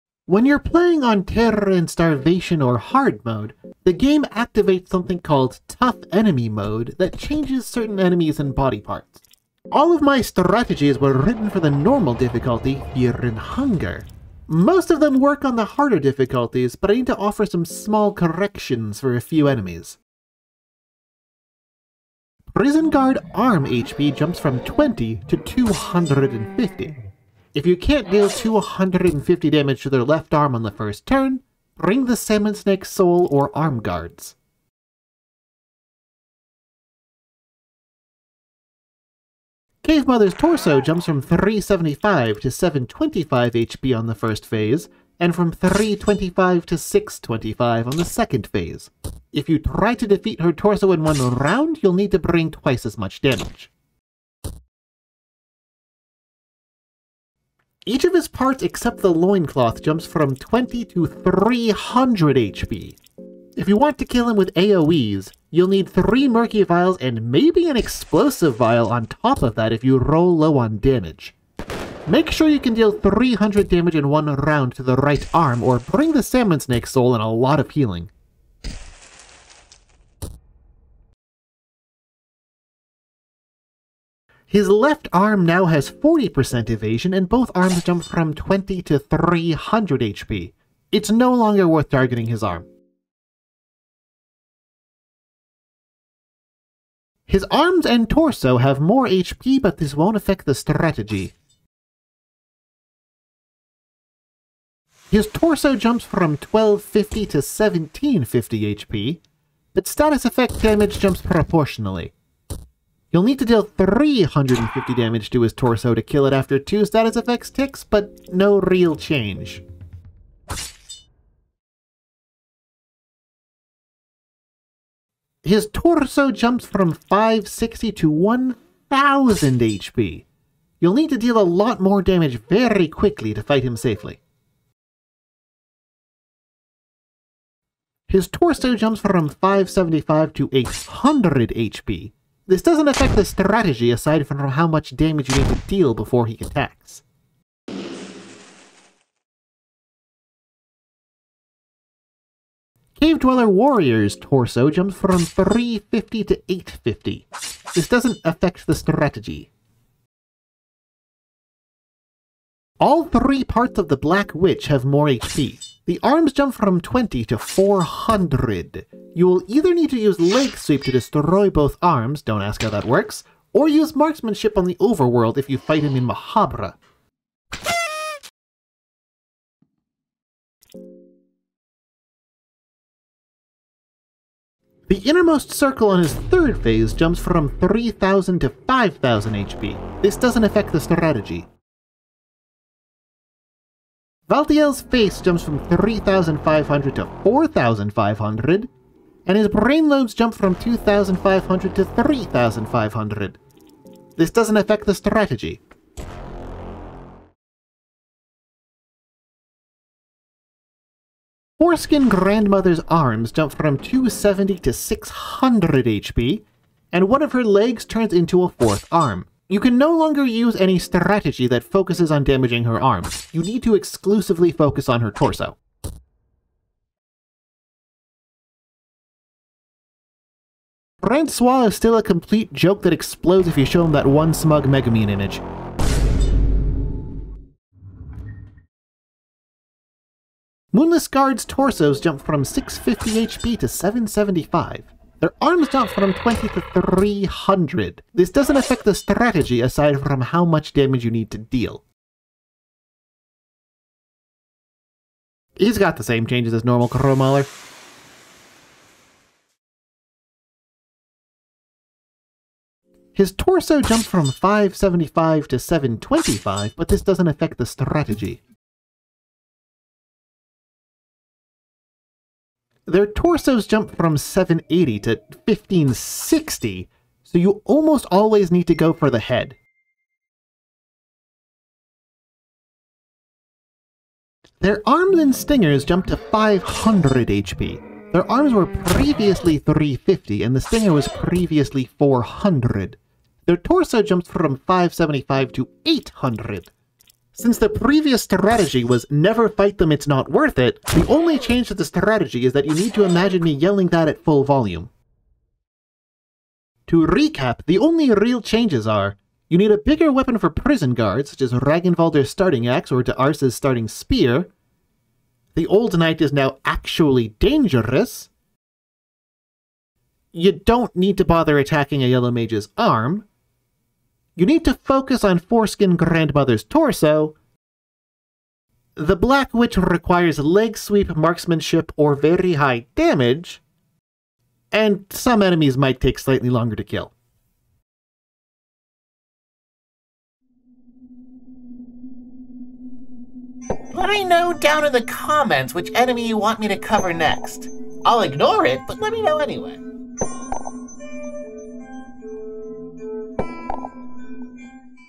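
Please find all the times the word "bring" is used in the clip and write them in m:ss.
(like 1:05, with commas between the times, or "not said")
0:31, 0:52, 1:15.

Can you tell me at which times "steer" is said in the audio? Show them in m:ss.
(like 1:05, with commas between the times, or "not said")
not said.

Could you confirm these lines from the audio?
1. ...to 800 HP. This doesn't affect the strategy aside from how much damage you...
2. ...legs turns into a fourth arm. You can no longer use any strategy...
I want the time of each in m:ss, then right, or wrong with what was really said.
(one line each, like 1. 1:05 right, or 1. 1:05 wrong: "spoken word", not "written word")
1. 2:20 right
2. 3:37 right.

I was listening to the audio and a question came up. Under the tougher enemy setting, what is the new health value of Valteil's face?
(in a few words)
4500.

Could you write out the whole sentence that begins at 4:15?
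He's got the same changes as normal Crowmauler.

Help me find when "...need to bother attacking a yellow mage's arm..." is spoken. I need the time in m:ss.
5:20.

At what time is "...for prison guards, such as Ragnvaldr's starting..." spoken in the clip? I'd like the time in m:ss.
5:10.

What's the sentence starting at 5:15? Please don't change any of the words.
The old knight is now actually dangerous.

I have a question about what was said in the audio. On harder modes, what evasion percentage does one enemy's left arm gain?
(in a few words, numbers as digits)
40%.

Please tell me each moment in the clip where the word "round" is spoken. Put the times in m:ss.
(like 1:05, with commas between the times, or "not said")
0:51, 1:14.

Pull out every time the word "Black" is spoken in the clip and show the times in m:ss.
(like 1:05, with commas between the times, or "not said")
2:43, 5:29.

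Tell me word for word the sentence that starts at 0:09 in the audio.
All of my strategies were written for the normal difficulty, Fear and Hunger.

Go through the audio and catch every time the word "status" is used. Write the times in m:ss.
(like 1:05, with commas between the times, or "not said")
1:49, 1:56.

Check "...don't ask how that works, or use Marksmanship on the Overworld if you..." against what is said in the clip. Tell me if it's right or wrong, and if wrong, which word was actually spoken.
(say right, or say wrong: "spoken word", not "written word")
right.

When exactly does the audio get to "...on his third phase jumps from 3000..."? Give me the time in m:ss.
3:05.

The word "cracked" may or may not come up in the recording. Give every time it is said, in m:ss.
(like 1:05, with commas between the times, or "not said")
not said.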